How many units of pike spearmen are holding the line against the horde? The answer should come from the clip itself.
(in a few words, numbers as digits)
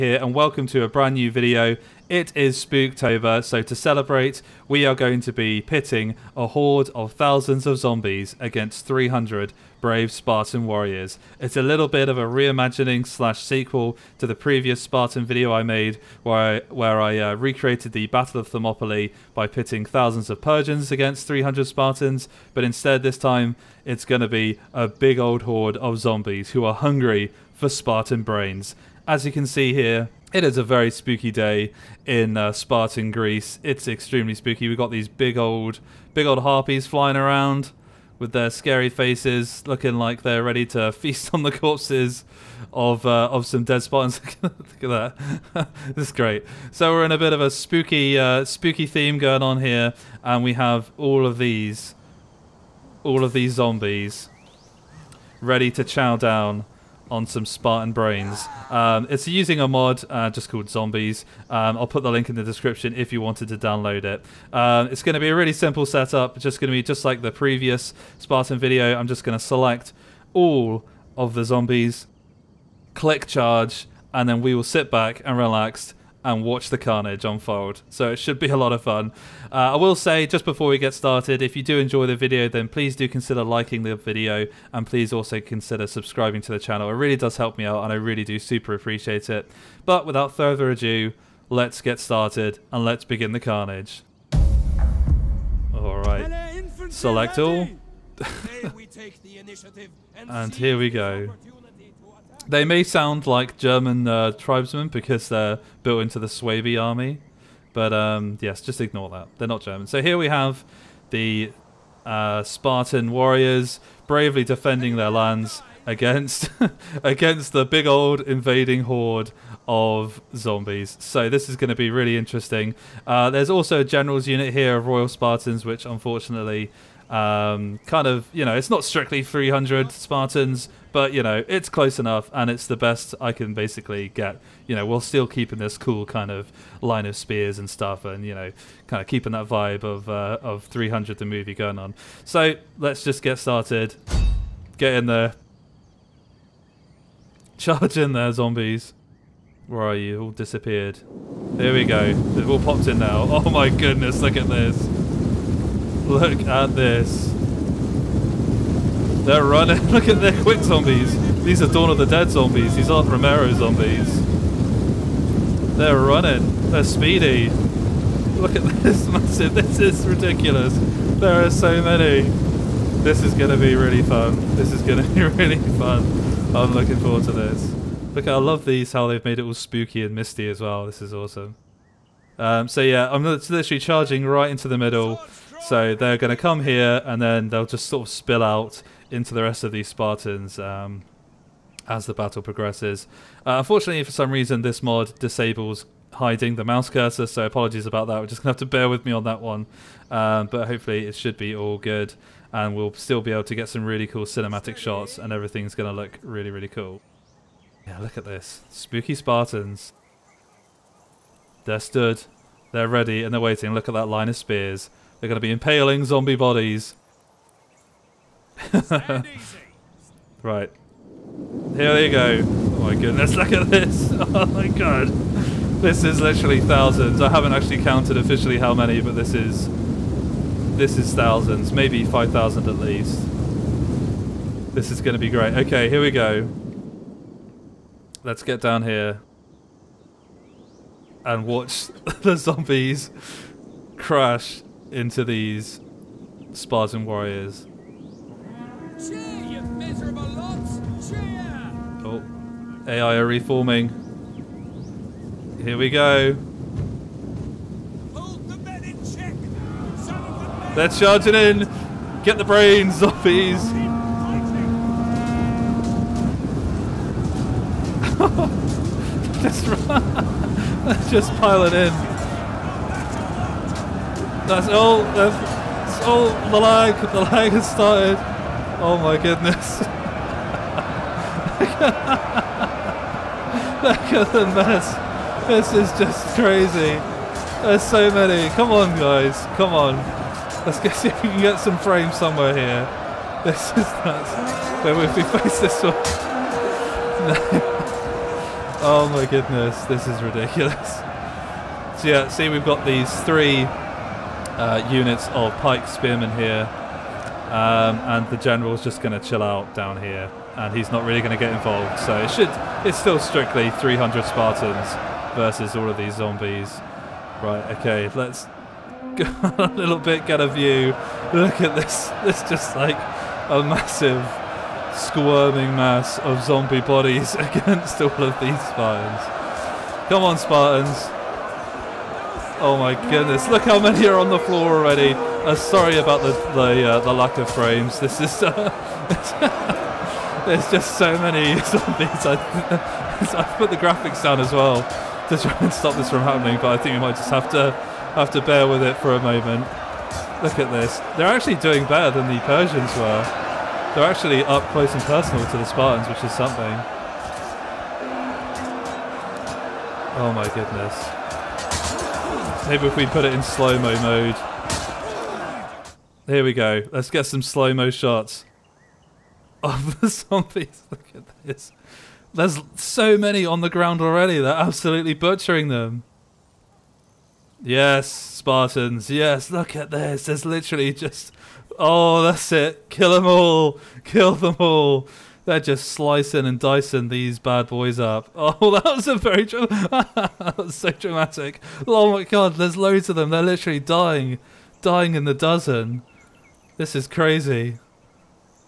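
3.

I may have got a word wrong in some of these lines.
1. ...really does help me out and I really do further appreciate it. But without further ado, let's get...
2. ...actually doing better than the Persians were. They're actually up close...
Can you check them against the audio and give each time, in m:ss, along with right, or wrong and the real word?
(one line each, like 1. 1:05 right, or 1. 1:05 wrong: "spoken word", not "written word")
1. 1:26 wrong: "super", not "further"
2. 5:51 right.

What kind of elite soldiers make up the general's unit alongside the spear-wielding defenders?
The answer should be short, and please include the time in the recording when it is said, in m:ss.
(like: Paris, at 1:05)
Royal Spartans, at 2:04.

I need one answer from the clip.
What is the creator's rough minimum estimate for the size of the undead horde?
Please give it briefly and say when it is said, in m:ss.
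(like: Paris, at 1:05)
5,000, at 3:52.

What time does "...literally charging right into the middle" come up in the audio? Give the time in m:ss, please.
3:03.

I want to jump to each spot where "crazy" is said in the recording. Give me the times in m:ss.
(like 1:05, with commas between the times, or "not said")
4:46, 6:37.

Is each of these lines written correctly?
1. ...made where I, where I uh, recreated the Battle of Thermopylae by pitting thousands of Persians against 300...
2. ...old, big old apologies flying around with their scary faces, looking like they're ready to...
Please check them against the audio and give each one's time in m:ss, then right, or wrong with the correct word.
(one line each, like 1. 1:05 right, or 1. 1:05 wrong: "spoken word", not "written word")
1. 0:15 right
2. 0:35 wrong: "harpies", not "apologies".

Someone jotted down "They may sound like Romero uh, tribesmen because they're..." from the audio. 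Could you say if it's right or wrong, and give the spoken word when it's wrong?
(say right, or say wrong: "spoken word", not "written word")
wrong: "German", not "Romero".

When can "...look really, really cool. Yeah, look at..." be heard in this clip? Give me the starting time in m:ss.
3:25.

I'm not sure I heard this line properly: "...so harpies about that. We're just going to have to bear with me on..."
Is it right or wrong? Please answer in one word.
wrong.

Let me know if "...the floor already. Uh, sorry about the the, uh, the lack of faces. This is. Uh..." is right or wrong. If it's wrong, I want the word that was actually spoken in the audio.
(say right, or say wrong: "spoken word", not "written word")
wrong: "frames", not "faces".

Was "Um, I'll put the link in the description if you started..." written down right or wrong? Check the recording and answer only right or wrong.
wrong.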